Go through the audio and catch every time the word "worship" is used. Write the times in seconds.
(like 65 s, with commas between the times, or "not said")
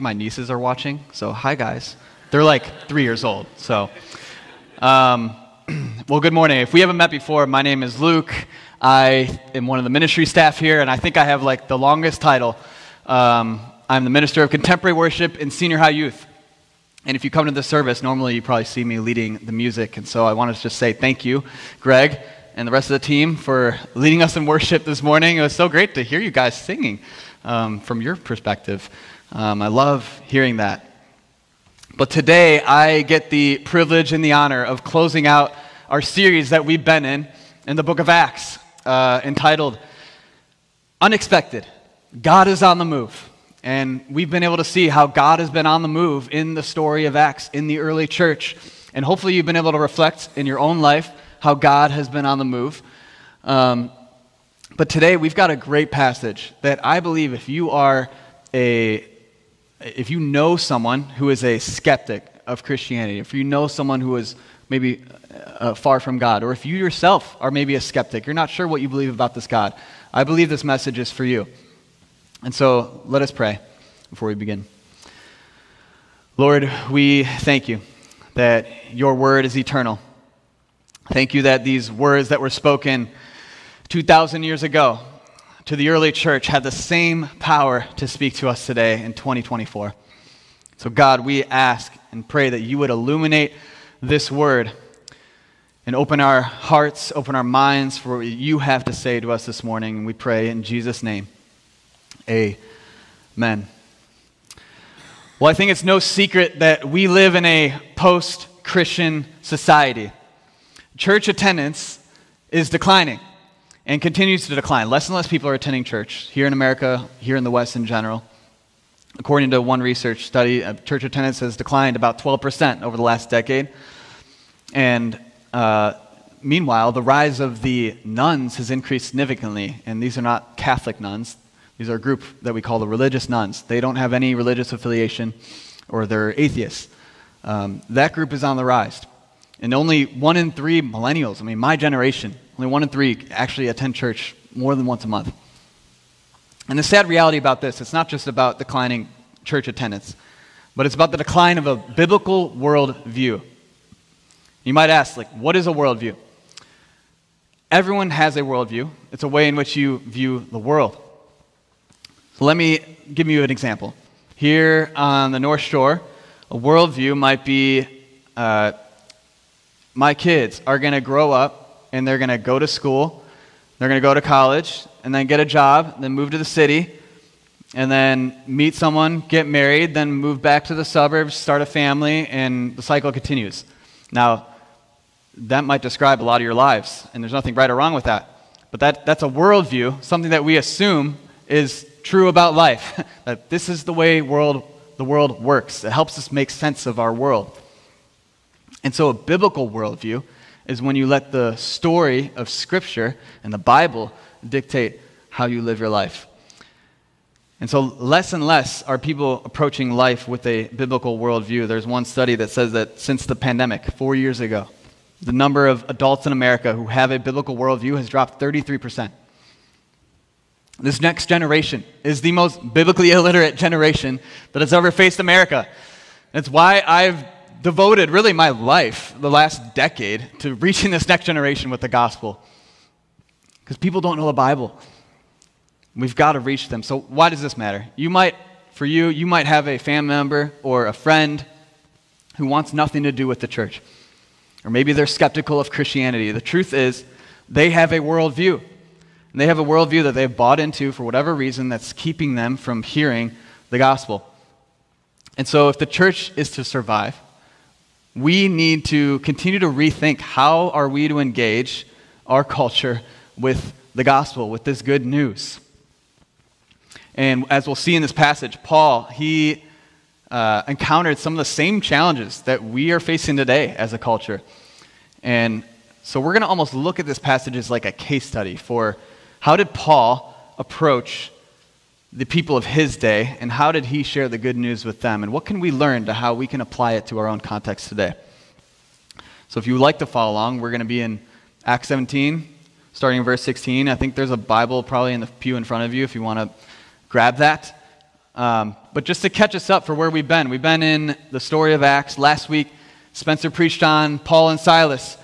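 14 s, 24 s.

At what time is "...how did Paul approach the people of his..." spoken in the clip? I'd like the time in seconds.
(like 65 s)
279 s.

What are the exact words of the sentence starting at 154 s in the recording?
You might ask, like, what is a worldview?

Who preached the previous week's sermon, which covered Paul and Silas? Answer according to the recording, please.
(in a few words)
Spencer.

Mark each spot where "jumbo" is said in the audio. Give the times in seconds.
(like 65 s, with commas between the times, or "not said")
not said.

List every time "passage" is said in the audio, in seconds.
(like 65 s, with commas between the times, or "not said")
55 s, 268 s, 277 s.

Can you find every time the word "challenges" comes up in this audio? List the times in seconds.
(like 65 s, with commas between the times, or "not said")
271 s.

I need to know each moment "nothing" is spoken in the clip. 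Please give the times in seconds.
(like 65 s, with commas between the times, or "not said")
187 s, 242 s.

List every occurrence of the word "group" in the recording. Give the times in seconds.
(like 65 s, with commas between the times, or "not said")
131 s, 138 s.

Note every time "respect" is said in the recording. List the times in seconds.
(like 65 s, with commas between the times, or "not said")
not said.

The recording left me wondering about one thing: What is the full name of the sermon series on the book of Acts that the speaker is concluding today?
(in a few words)
Unexpected God is on the Move.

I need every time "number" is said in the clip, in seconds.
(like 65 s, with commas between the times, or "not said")
215 s.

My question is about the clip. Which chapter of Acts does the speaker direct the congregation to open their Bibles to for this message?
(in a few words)
Acts 17.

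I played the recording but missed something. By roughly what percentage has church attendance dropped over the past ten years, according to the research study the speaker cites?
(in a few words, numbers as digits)
12%.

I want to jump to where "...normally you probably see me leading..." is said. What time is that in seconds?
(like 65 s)
18 s.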